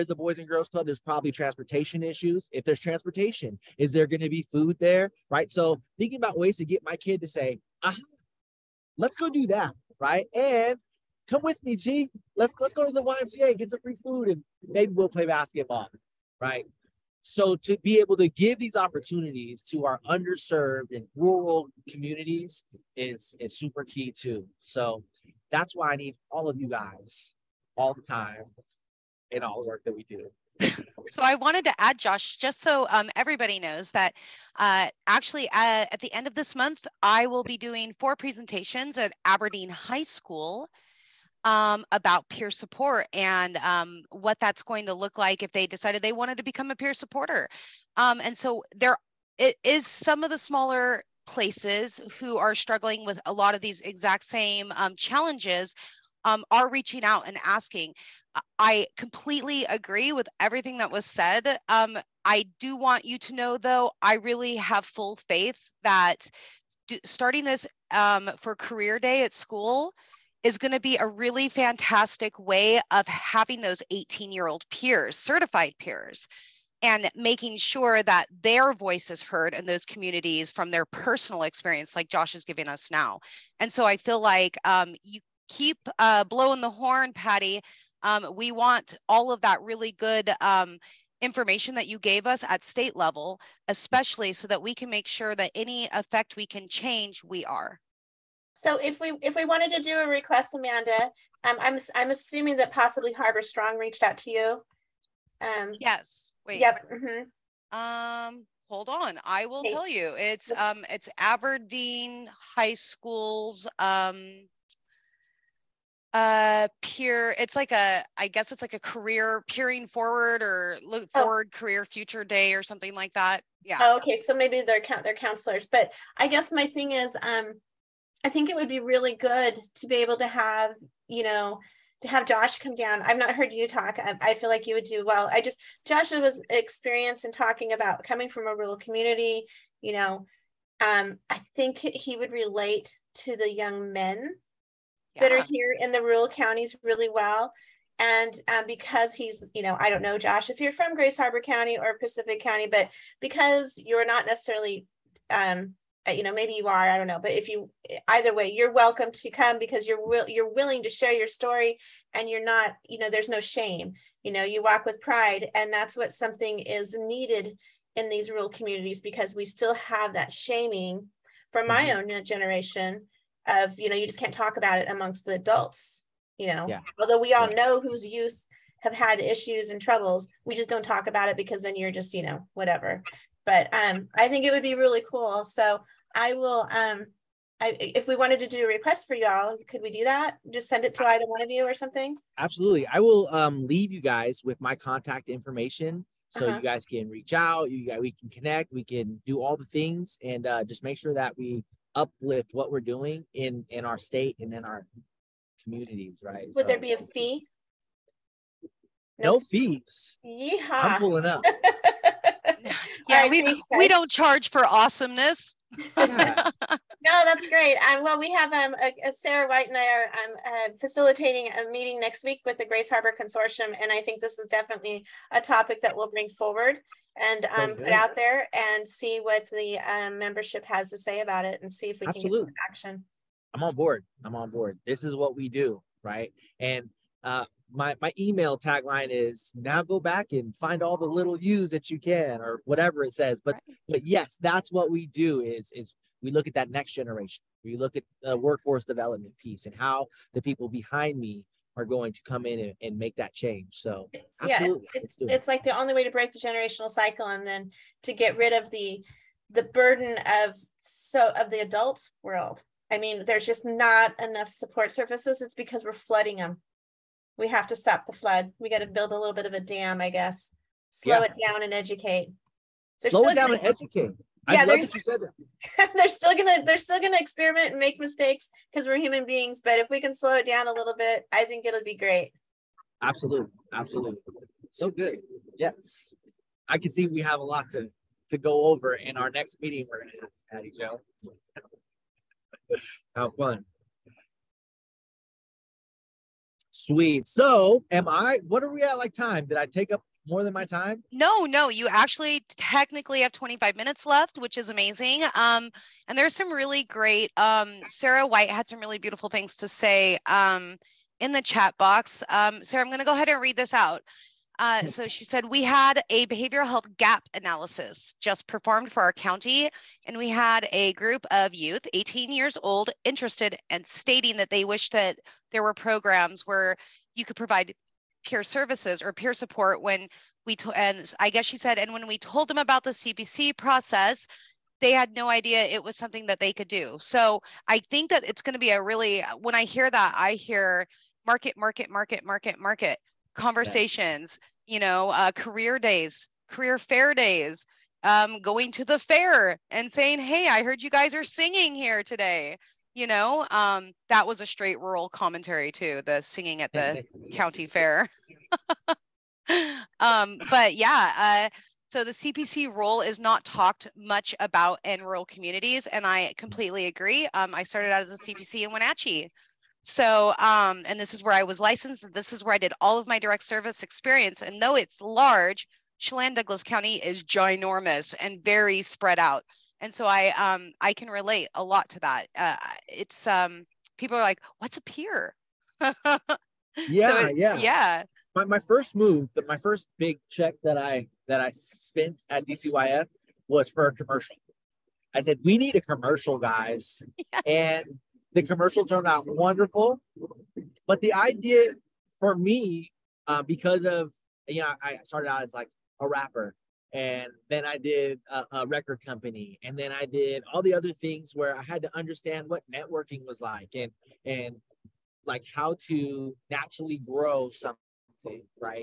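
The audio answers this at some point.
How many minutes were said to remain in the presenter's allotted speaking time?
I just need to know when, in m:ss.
5:03.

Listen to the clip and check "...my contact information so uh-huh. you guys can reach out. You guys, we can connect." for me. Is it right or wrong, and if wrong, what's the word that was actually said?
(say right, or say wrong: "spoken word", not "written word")
right.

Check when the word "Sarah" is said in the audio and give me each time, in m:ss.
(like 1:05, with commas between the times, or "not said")
3:39, 5:07, 5:12.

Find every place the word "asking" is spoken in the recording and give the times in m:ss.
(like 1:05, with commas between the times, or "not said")
0:57.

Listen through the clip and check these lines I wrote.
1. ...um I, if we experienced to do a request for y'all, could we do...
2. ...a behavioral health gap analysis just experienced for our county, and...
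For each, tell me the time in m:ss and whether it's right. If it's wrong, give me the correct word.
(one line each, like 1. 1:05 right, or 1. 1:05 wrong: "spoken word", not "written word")
1. 3:06 wrong: "wanted", not "experienced"
2. 5:16 wrong: "performed", not "experienced".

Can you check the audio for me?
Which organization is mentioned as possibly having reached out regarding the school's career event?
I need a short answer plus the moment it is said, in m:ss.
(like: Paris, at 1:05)
Harbor Strong, at 1:43.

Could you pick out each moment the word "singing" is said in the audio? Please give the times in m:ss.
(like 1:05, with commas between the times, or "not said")
5:51, 5:56.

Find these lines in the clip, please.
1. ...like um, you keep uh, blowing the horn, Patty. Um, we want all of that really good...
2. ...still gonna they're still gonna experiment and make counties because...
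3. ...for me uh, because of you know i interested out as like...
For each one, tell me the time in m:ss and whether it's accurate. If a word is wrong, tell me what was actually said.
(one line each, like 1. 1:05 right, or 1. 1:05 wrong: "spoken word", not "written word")
1. 1:24 right
2. 4:36 wrong: "mistakes", not "counties"
3. 6:42 wrong: "started", not "interested".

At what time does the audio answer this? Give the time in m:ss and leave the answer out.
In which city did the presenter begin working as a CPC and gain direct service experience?
6:08.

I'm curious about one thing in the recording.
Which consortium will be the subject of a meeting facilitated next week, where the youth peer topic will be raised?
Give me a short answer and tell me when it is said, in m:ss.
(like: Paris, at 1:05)
Grays Harbor Consortium, at 3:42.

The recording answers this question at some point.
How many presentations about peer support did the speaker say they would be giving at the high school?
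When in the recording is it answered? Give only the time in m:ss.
0:37.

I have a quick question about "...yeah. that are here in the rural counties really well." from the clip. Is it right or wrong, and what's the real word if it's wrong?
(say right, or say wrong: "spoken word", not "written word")
right.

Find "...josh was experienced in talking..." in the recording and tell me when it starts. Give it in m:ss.
2:15.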